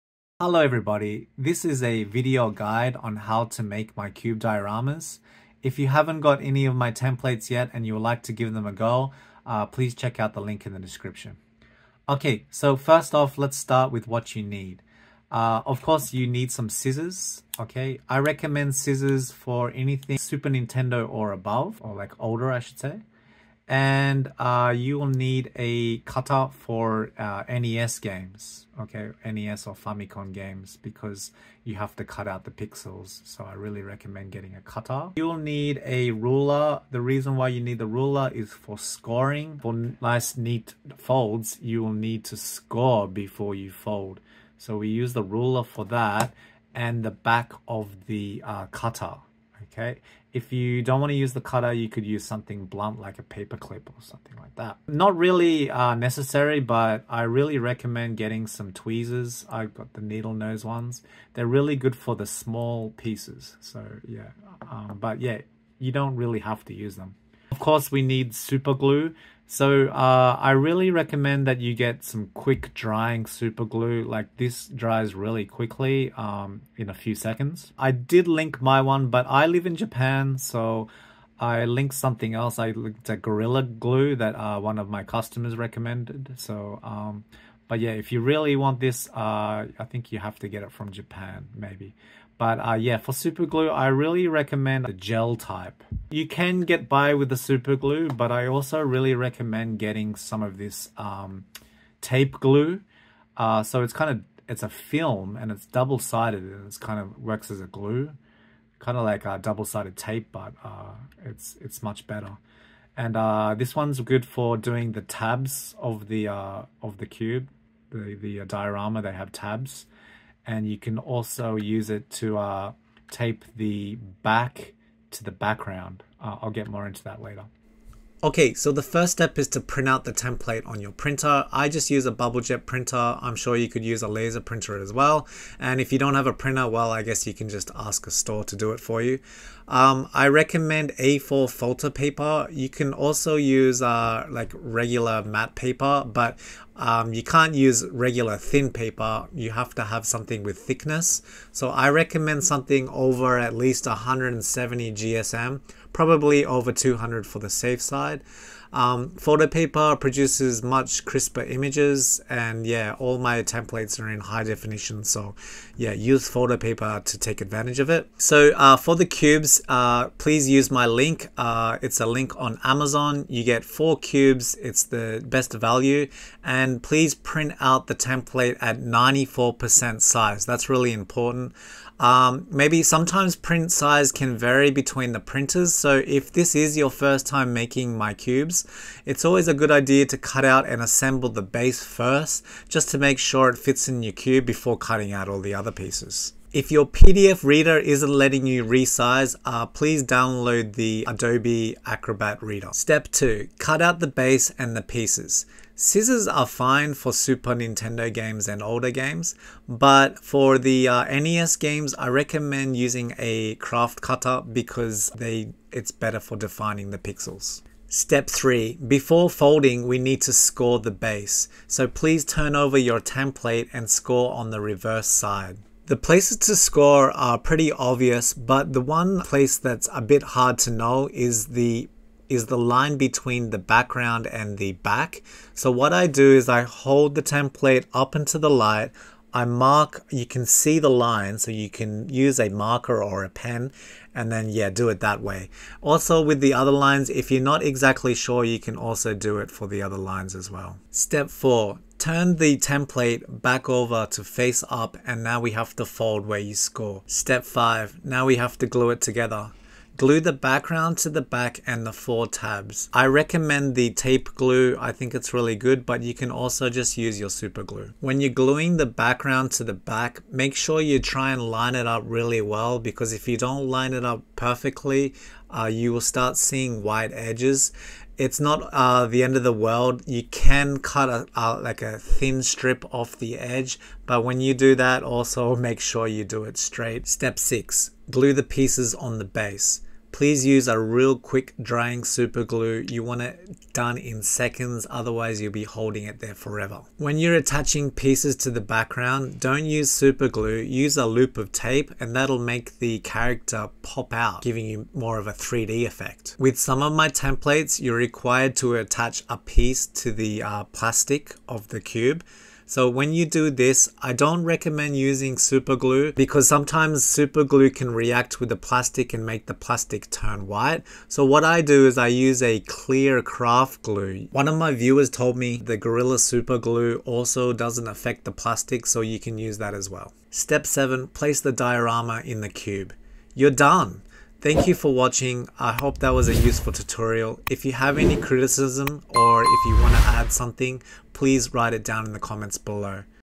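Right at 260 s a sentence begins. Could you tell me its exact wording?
Glue the background to the back and the four tabs.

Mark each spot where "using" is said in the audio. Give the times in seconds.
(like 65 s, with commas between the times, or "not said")
212 s, 314 s.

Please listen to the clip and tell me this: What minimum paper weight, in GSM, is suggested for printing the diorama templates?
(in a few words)
170.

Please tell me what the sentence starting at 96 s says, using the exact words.
You can get by with the super glue, but I also really recommend getting some of this um, tape glue.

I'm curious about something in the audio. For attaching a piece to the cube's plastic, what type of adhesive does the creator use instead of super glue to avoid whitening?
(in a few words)
clear craft glue.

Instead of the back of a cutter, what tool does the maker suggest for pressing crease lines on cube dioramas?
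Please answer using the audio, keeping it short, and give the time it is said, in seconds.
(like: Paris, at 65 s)
a paper clip, at 53 s.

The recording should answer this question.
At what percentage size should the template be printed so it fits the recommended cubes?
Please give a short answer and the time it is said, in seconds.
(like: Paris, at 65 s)
94%, at 178 s.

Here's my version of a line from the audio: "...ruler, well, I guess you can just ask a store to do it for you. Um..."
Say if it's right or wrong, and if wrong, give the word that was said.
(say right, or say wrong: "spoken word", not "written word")
wrong: "printer", not "ruler".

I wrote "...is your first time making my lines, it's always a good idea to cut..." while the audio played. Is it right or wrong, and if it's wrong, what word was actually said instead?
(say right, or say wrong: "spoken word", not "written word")
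wrong: "cubes", not "lines".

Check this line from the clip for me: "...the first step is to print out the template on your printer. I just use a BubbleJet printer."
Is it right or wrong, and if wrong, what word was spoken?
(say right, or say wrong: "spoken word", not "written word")
right.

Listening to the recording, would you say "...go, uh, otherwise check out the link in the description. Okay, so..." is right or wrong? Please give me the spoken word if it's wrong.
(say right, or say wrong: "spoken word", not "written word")
wrong: "please", not "otherwise".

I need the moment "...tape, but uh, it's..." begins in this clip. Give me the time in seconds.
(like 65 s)
109 s.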